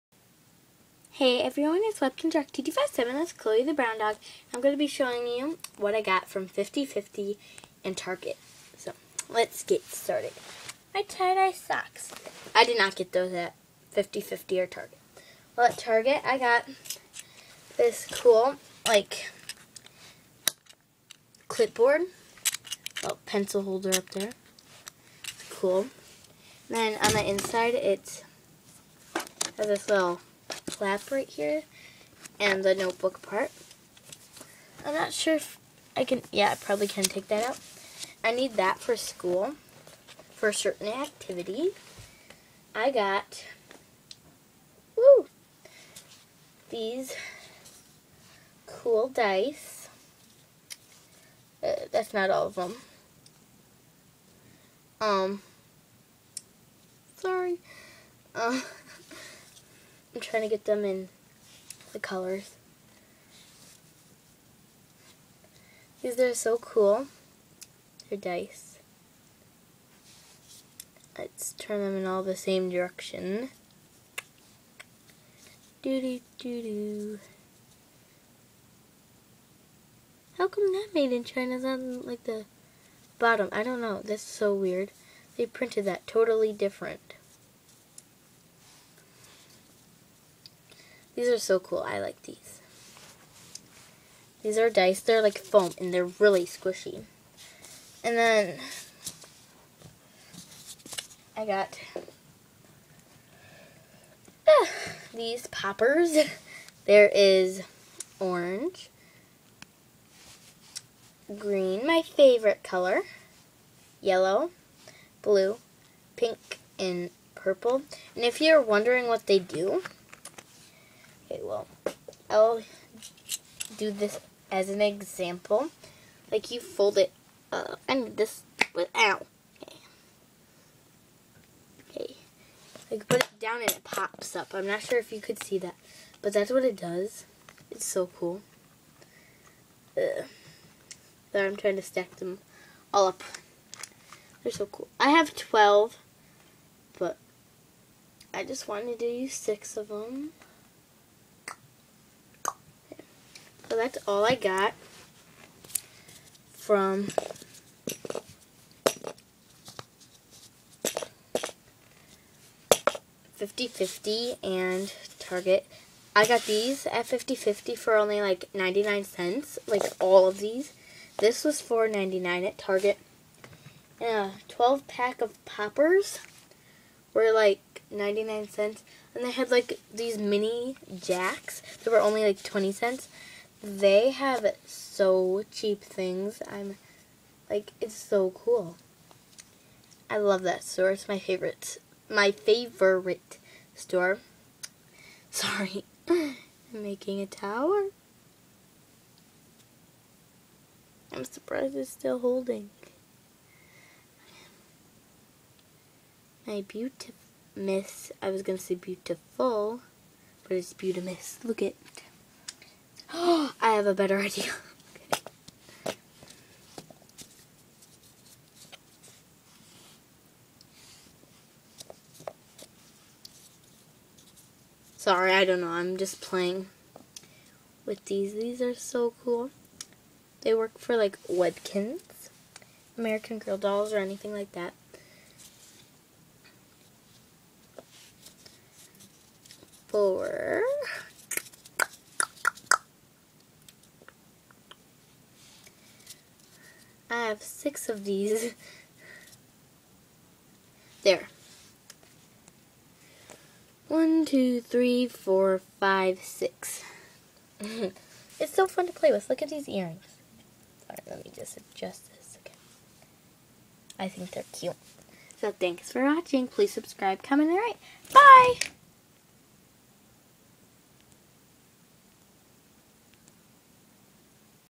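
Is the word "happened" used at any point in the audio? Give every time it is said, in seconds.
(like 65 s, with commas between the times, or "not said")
not said.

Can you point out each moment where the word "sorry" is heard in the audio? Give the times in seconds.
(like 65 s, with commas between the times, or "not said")
57 s, 195 s, 224 s.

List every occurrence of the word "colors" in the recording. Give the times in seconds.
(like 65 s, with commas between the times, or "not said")
61 s, 112 s.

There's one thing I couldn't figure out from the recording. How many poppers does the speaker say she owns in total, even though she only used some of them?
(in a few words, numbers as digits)
12.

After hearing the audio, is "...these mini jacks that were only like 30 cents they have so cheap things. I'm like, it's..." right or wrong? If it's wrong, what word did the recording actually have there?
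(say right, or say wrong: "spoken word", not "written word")
wrong: "20", not "30".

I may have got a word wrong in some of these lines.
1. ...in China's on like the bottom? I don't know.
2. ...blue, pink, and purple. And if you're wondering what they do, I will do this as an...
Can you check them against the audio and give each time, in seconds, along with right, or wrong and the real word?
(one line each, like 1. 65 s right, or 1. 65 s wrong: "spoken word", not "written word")
1. 81 s right
2. 115 s right.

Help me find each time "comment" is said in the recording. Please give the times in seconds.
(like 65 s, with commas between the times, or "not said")
267 s.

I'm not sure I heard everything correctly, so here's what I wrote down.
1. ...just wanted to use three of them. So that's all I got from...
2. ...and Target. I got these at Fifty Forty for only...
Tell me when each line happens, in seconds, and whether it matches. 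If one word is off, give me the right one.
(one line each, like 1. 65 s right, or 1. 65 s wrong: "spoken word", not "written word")
1. 148 s wrong: "six", not "three"
2. 164 s wrong: "Fifty", not "Forty".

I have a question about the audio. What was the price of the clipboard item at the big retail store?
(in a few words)
$4.99.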